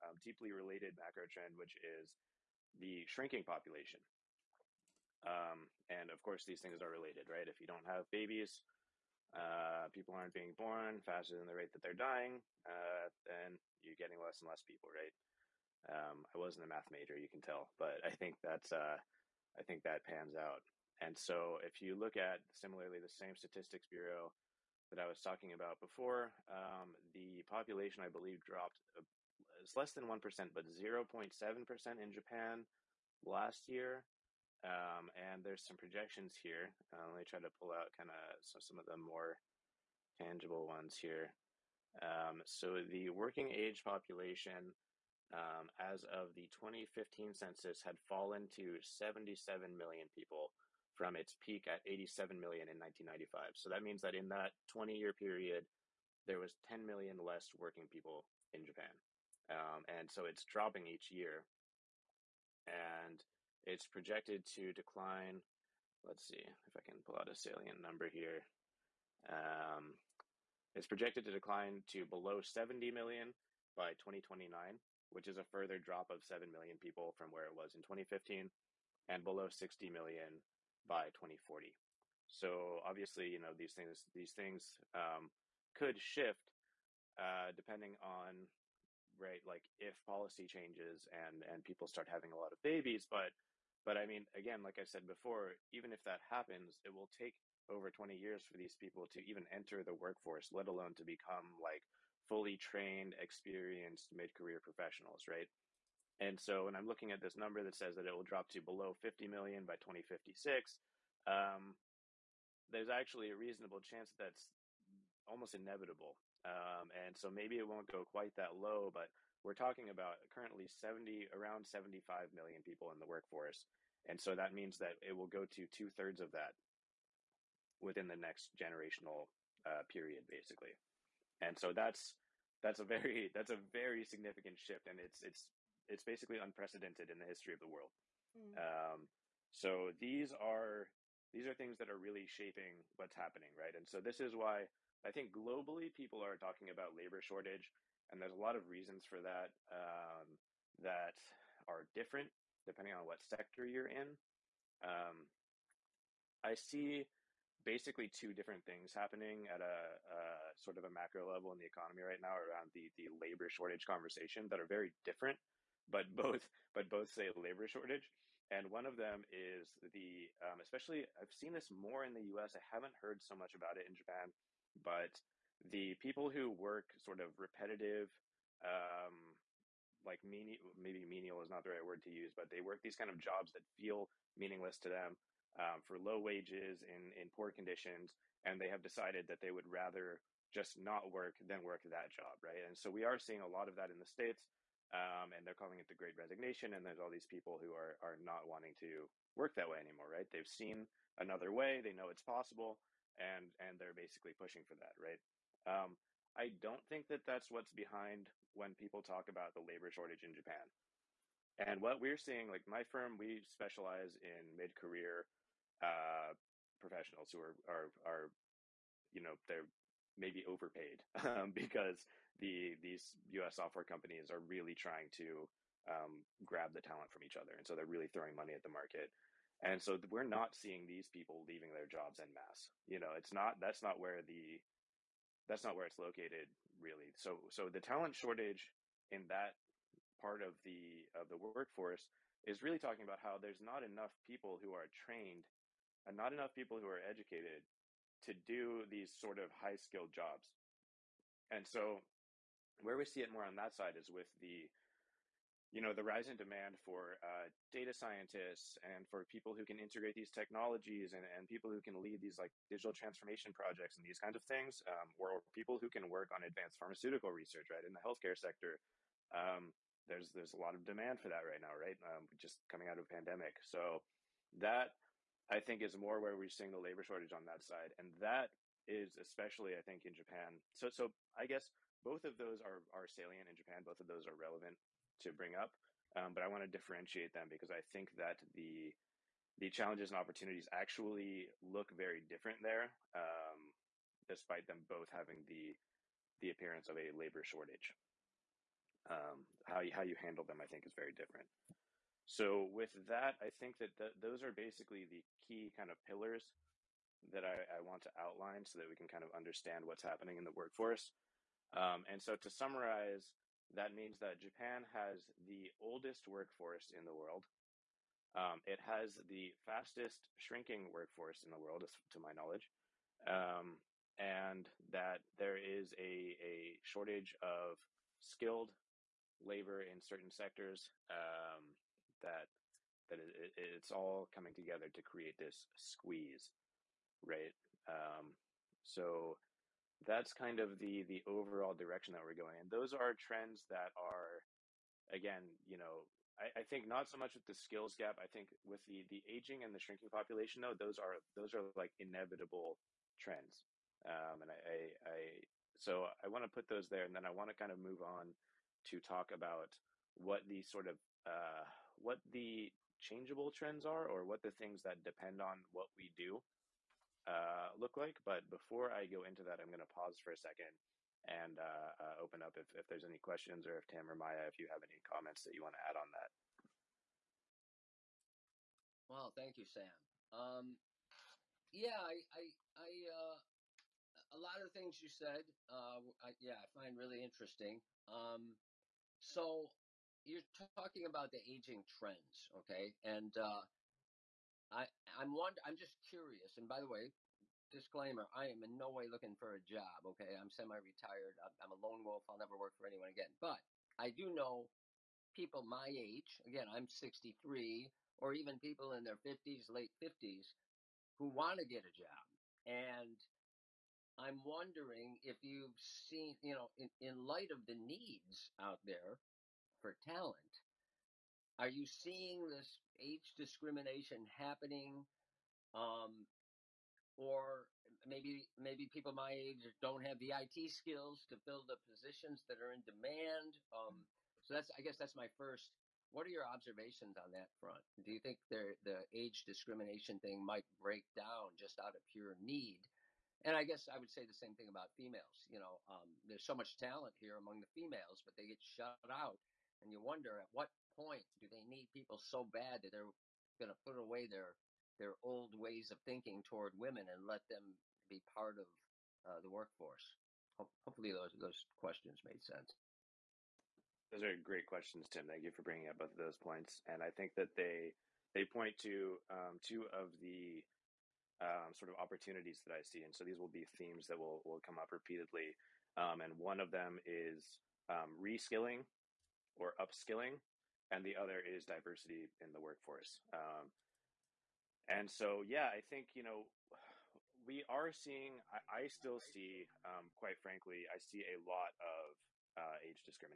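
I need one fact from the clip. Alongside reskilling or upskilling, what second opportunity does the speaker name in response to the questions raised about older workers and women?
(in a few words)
Diversity in the workforce.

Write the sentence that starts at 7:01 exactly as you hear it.
Are you seeing this age discrimination happening?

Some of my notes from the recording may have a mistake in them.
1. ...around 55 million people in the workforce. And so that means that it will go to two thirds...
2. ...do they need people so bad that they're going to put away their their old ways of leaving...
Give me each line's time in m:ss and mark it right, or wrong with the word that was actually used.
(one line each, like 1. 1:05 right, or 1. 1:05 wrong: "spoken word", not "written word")
1. 2:01 wrong: "75", not "55"
2. 7:31 wrong: "thinking", not "leaving".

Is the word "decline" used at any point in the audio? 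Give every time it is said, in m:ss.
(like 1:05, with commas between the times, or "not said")
1:04, 1:11.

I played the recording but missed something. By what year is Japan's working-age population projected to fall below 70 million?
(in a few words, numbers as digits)
2029.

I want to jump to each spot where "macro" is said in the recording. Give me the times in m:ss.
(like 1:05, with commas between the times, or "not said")
0:00, 2:40.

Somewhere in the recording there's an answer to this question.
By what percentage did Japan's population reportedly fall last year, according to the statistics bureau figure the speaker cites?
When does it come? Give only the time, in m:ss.
0:30.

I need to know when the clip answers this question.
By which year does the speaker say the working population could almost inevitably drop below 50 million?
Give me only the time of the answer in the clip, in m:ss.
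1:49.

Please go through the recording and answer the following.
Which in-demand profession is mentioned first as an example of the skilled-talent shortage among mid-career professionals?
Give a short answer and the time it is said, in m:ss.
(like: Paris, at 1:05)
Data scientists, at 4:17.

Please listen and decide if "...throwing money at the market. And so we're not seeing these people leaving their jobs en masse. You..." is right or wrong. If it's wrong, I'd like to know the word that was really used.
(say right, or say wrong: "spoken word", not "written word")
right.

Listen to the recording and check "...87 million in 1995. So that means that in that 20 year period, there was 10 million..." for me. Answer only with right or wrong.
right.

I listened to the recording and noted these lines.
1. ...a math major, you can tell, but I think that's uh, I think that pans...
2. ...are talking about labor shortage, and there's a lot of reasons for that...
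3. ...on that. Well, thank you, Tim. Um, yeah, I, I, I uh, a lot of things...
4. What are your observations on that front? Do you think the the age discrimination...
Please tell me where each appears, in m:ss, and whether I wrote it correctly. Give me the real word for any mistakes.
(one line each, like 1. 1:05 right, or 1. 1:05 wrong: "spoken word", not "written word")
1. 0:16 right
2. 2:26 right
3. 6:15 wrong: "Sam", not "Tim"
4. 7:16 right.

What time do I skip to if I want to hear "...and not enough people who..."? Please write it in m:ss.
4:06.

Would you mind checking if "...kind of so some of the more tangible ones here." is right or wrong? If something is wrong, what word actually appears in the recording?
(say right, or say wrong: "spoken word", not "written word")
right.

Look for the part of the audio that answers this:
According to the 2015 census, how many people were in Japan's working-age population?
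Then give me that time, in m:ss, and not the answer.
0:48.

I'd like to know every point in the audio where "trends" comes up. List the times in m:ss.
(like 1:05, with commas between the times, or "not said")
0:01, 5:43, 5:53, 6:03, 6:31.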